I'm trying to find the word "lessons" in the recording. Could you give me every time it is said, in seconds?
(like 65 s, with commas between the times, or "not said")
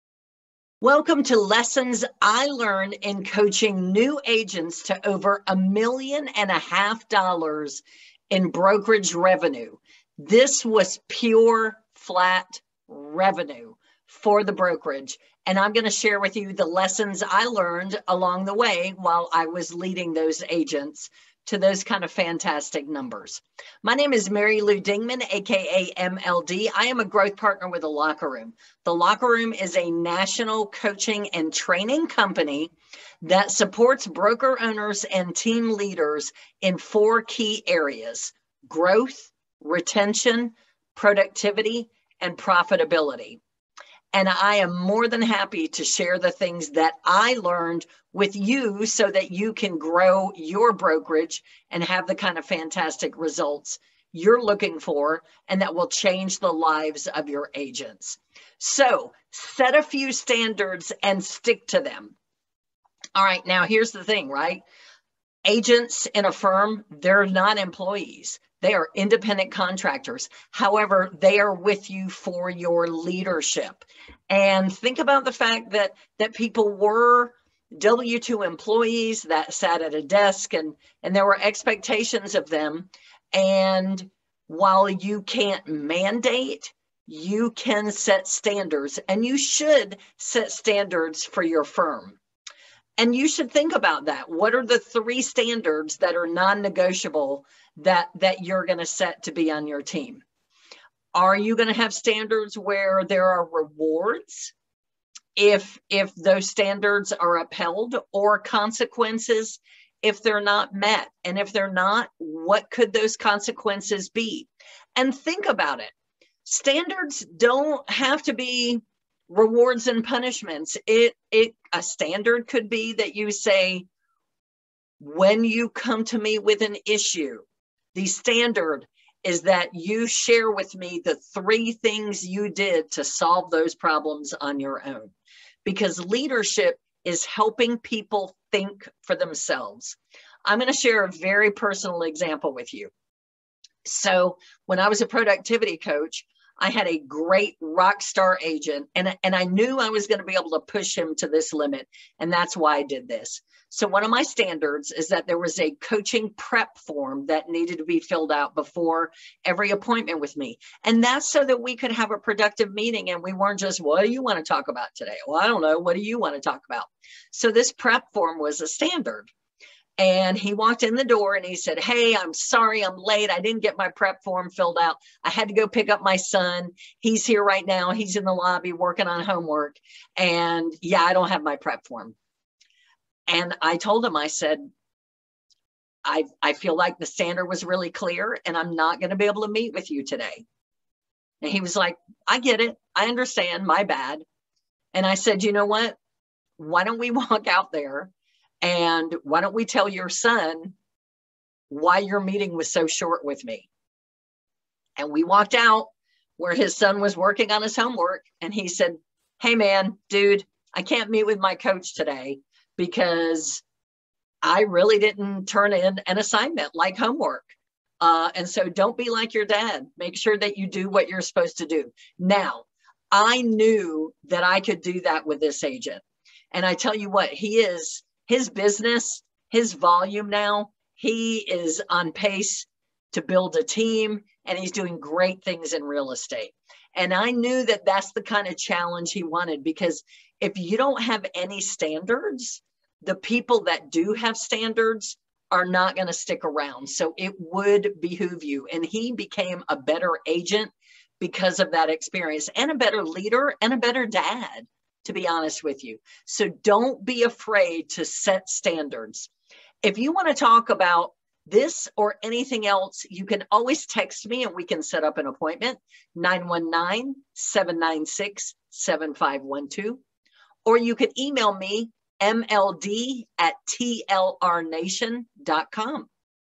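1 s, 16 s.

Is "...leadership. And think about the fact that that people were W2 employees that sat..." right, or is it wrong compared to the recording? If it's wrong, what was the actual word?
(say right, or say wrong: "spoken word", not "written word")
right.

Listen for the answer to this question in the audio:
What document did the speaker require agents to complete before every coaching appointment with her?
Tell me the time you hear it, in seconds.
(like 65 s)
155 s.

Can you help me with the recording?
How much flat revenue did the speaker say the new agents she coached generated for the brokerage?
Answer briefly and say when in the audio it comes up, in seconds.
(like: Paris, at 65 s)
Over $1.5 million, at 5 s.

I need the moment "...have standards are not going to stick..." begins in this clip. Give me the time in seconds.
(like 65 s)
244 s.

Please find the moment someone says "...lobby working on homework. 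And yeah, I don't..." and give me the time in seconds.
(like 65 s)
178 s.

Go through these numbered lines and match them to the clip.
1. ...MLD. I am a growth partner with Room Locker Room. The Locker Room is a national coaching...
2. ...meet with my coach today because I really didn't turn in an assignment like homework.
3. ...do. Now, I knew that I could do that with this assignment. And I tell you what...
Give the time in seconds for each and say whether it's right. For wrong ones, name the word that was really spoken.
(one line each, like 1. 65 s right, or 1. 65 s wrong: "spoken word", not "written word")
1. 25 s wrong: "The", not "Room"
2. 211 s right
3. 221 s wrong: "agent", not "assignment".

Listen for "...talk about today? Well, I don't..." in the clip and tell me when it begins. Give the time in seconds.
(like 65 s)
164 s.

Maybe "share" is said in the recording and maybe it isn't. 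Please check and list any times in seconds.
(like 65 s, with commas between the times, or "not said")
15 s, 45 s, 130 s, 140 s.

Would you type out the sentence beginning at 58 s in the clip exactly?
So set a few standards and stick to them.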